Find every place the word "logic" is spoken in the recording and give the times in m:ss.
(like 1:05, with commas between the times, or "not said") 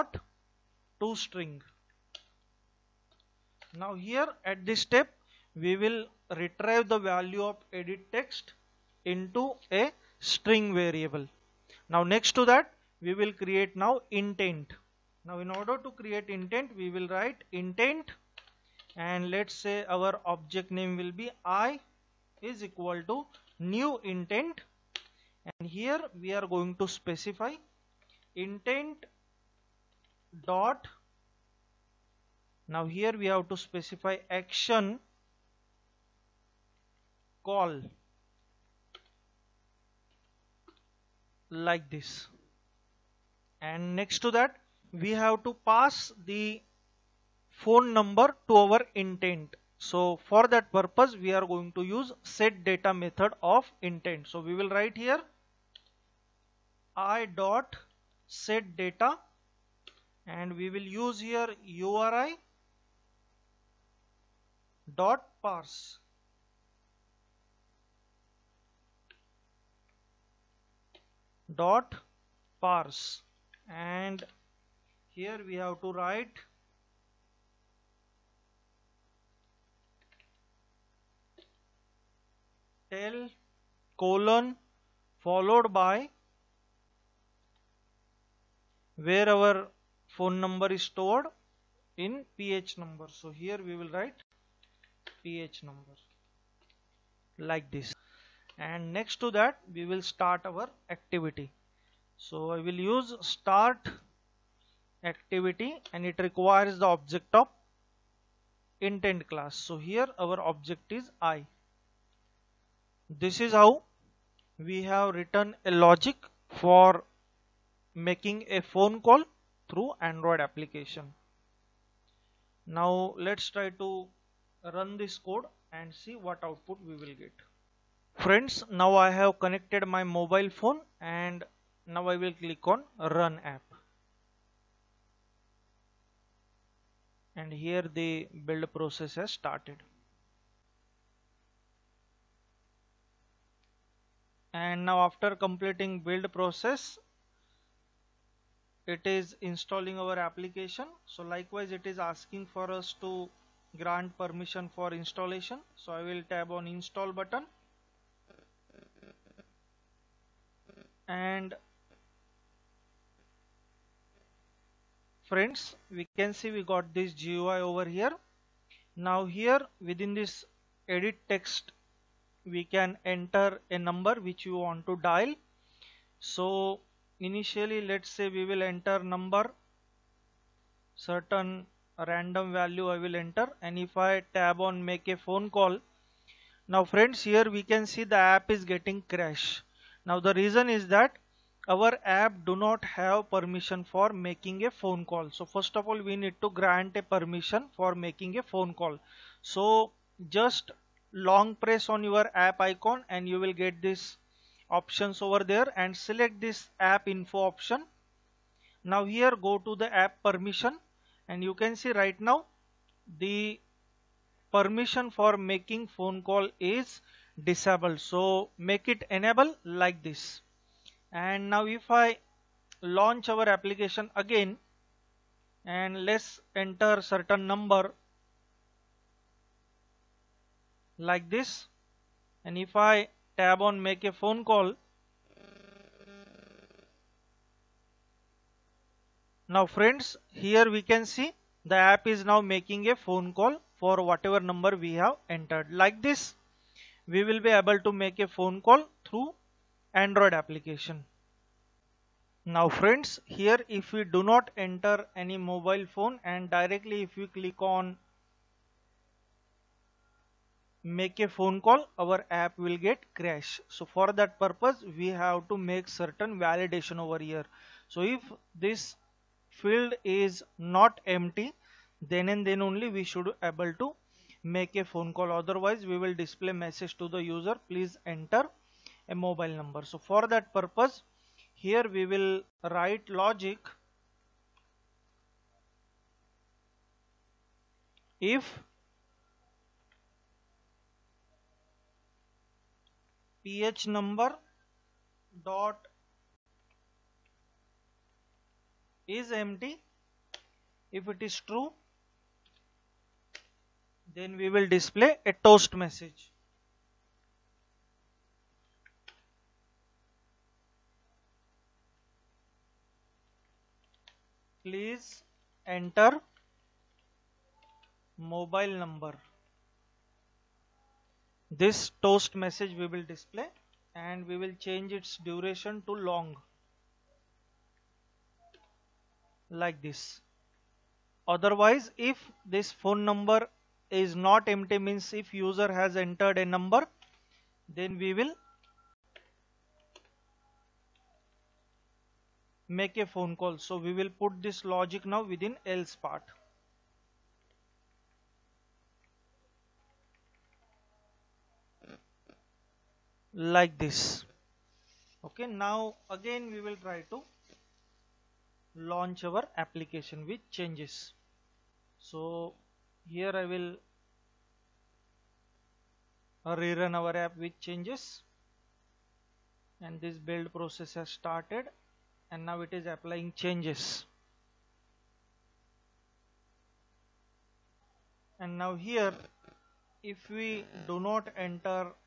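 1:55, 4:43, 5:44.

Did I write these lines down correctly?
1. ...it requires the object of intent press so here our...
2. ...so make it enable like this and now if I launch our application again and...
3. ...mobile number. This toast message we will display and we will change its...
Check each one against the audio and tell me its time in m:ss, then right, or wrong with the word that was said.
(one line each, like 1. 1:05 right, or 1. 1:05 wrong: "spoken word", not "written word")
1. 1:46 wrong: "class", not "press"
2. 3:37 right
3. 5:18 right.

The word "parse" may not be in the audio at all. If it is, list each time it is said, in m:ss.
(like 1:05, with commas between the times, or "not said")
1:05, 1:12.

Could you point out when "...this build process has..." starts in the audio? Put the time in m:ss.
6:09.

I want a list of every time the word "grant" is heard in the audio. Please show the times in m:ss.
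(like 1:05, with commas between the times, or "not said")
2:33, 3:16.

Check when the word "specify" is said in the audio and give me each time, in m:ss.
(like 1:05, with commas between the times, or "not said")
0:26, 0:33.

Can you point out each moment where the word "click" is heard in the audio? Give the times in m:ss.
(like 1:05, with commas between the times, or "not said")
2:12, 4:17.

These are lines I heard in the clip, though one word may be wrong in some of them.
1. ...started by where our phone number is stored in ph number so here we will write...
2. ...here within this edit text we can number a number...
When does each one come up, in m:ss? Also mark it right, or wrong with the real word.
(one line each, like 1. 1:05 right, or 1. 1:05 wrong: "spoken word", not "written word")
1. 1:25 wrong: "followed", not "started"
2. 2:49 wrong: "enter", not "number".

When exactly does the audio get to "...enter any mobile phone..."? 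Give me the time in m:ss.
4:14.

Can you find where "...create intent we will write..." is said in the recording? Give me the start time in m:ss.
0:15.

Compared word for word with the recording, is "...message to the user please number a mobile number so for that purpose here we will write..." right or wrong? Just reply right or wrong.
wrong.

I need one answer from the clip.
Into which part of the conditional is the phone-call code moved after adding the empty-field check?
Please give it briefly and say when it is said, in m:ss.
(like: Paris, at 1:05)
else part, at 5:45.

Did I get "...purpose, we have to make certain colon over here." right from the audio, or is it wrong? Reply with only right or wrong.
wrong.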